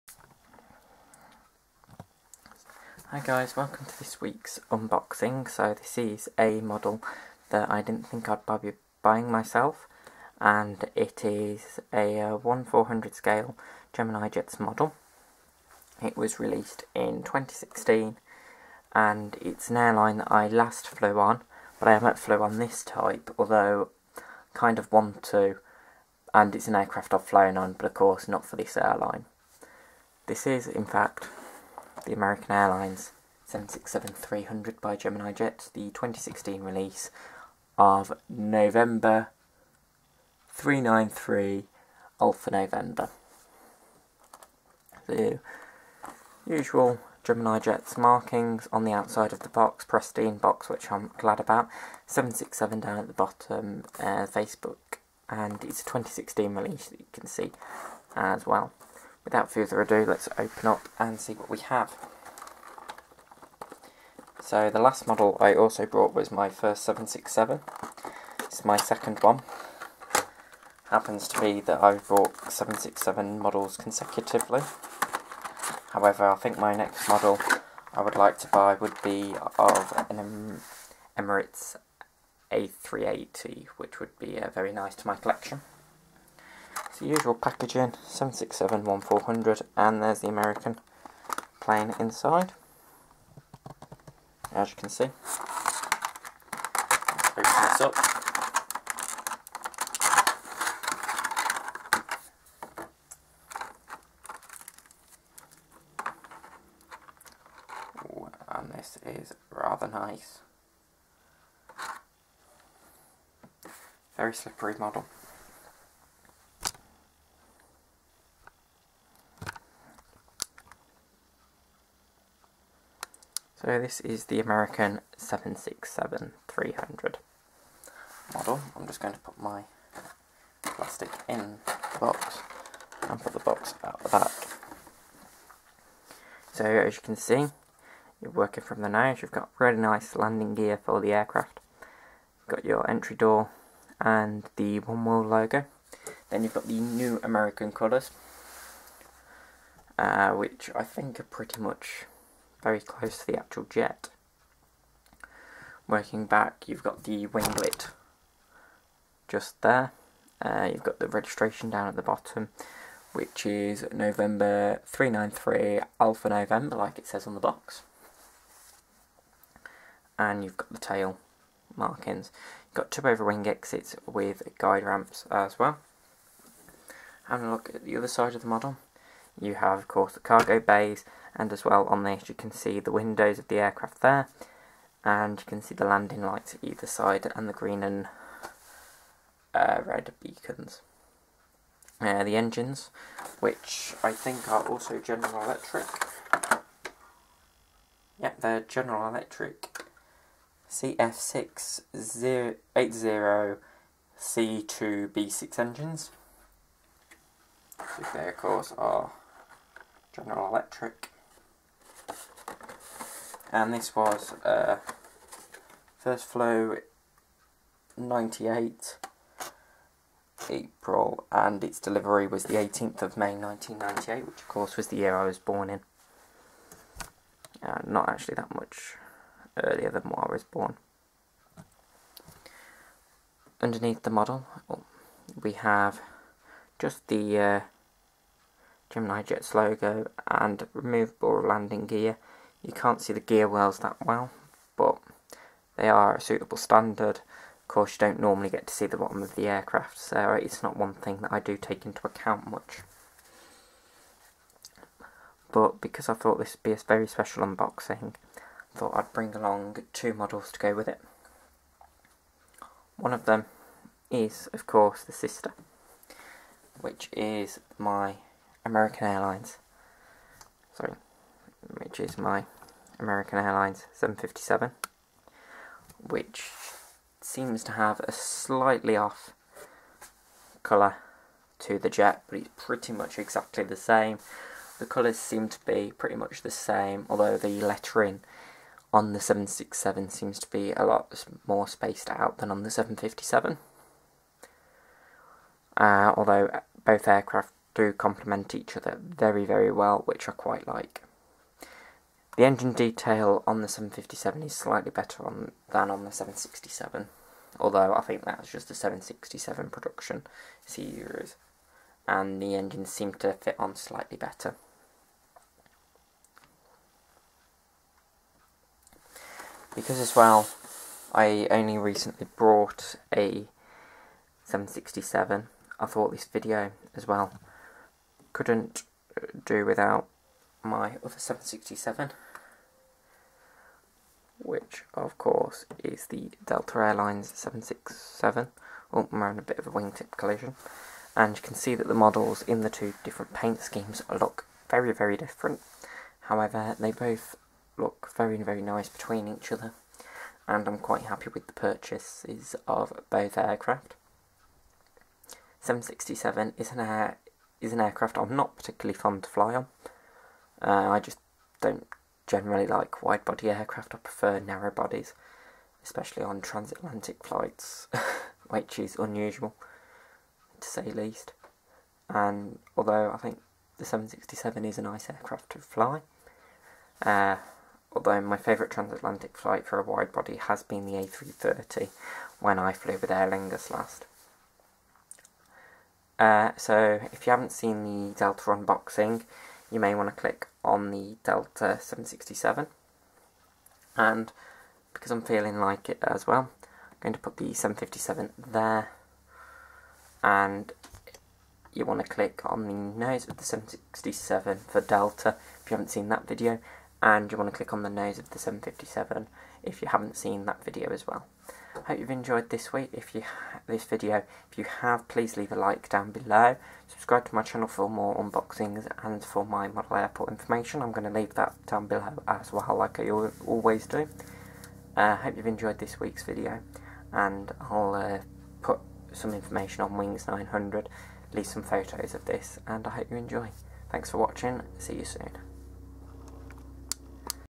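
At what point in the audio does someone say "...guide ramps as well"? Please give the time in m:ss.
2:54.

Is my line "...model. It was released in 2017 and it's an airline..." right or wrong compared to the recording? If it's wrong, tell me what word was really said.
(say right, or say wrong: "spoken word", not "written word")
wrong: "2016", not "2017".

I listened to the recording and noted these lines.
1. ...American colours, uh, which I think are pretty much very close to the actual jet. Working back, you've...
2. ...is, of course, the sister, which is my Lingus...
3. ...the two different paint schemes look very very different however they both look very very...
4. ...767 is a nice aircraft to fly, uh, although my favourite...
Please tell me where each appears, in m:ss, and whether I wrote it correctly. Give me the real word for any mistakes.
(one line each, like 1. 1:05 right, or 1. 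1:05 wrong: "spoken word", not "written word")
1. 2:27 right
2. 4:24 wrong: "American", not "Lingus"
3. 5:42 right
4. 6:13 right.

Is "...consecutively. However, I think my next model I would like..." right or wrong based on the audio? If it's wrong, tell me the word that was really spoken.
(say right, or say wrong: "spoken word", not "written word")
right.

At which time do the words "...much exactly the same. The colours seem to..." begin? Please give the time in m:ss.
4:42.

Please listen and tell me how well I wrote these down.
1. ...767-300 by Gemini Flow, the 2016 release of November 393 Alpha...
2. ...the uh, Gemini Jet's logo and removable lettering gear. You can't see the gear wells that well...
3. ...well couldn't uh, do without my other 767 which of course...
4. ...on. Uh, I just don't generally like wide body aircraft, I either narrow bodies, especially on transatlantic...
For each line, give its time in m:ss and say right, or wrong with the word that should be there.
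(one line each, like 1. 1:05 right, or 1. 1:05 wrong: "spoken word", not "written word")
1. 0:33 wrong: "Jet", not "Flow"
2. 3:57 wrong: "landing", not "lettering"
3. 5:27 right
4. 5:59 wrong: "prefer", not "either".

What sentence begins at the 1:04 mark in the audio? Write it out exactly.
So the last model I also brought was my first 767.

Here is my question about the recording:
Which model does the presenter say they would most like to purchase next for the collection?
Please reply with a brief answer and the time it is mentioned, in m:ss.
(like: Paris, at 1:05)
Emirates A380, at 1:21.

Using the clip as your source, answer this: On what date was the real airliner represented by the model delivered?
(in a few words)
18 May 1998.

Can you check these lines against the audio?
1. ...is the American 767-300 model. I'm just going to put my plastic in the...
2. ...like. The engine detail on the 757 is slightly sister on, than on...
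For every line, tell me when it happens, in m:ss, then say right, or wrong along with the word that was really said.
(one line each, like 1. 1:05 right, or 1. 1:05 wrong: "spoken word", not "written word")
1. 2:04 right
2. 5:00 wrong: "better", not "sister".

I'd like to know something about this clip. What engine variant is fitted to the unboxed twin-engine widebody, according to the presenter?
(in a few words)
CF6-80C2B6.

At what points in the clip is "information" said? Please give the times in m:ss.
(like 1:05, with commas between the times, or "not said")
7:00, 7:09.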